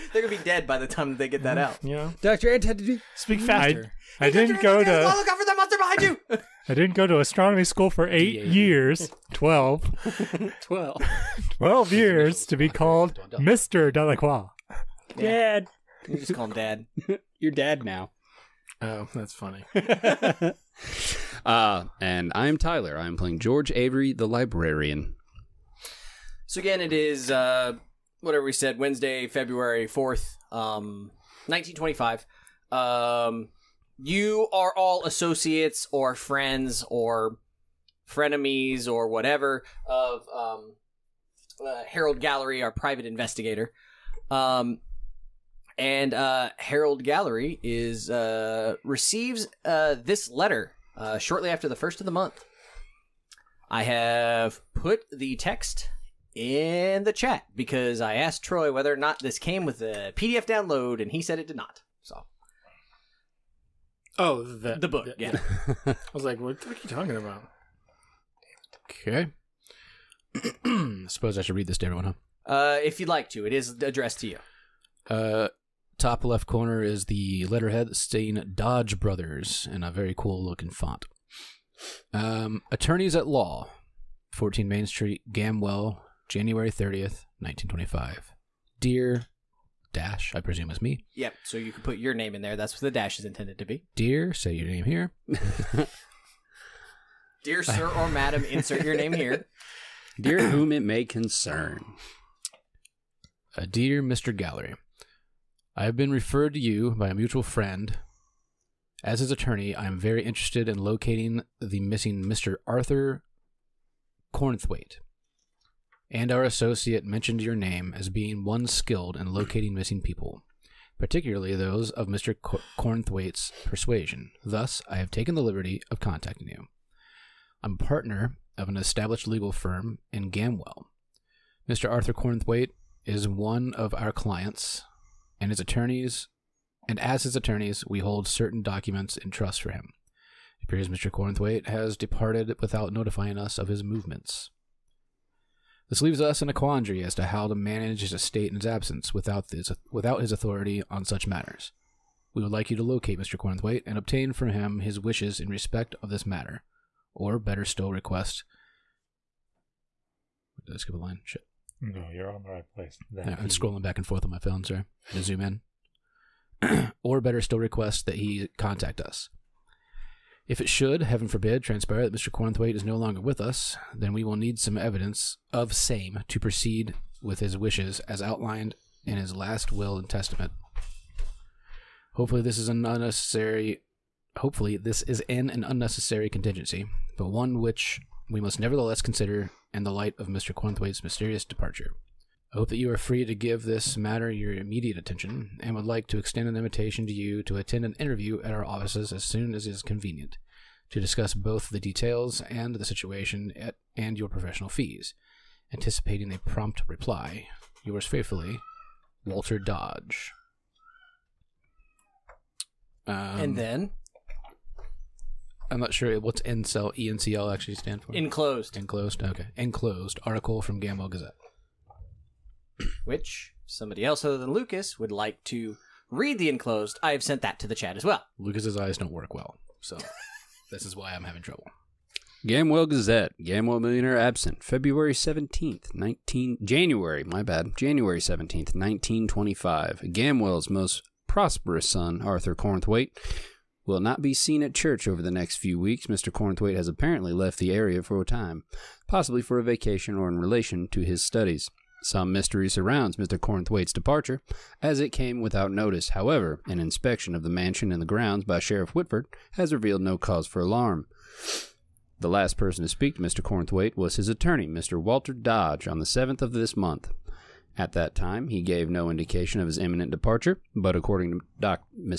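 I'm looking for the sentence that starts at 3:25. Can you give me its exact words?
Anticipating a prompt reply, yours faithfully, Walter Dodge.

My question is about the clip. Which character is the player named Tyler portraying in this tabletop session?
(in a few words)
George Avery.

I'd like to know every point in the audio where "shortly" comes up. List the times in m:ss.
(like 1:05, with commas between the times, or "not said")
0:51.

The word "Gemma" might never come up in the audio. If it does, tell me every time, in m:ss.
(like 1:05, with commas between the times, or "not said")
not said.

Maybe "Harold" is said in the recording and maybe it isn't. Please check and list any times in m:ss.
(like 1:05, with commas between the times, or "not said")
0:41, 0:46.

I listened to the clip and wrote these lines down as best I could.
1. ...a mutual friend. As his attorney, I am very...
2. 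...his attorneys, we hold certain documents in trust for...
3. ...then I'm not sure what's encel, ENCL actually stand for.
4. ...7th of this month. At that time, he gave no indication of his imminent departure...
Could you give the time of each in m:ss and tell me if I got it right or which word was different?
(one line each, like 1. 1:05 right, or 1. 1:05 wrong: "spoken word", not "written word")
1. 1:47 right
2. 2:17 right
3. 3:33 right
4. 4:26 right.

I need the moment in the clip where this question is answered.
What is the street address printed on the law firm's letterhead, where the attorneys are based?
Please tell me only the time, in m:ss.
1:24.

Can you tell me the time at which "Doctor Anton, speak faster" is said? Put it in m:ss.
0:02.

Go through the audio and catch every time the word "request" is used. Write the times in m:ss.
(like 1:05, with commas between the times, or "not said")
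2:37, 2:47.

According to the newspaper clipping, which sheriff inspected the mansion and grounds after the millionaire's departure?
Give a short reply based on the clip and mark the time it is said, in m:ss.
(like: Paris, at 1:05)
Sheriff Whitford, at 4:18.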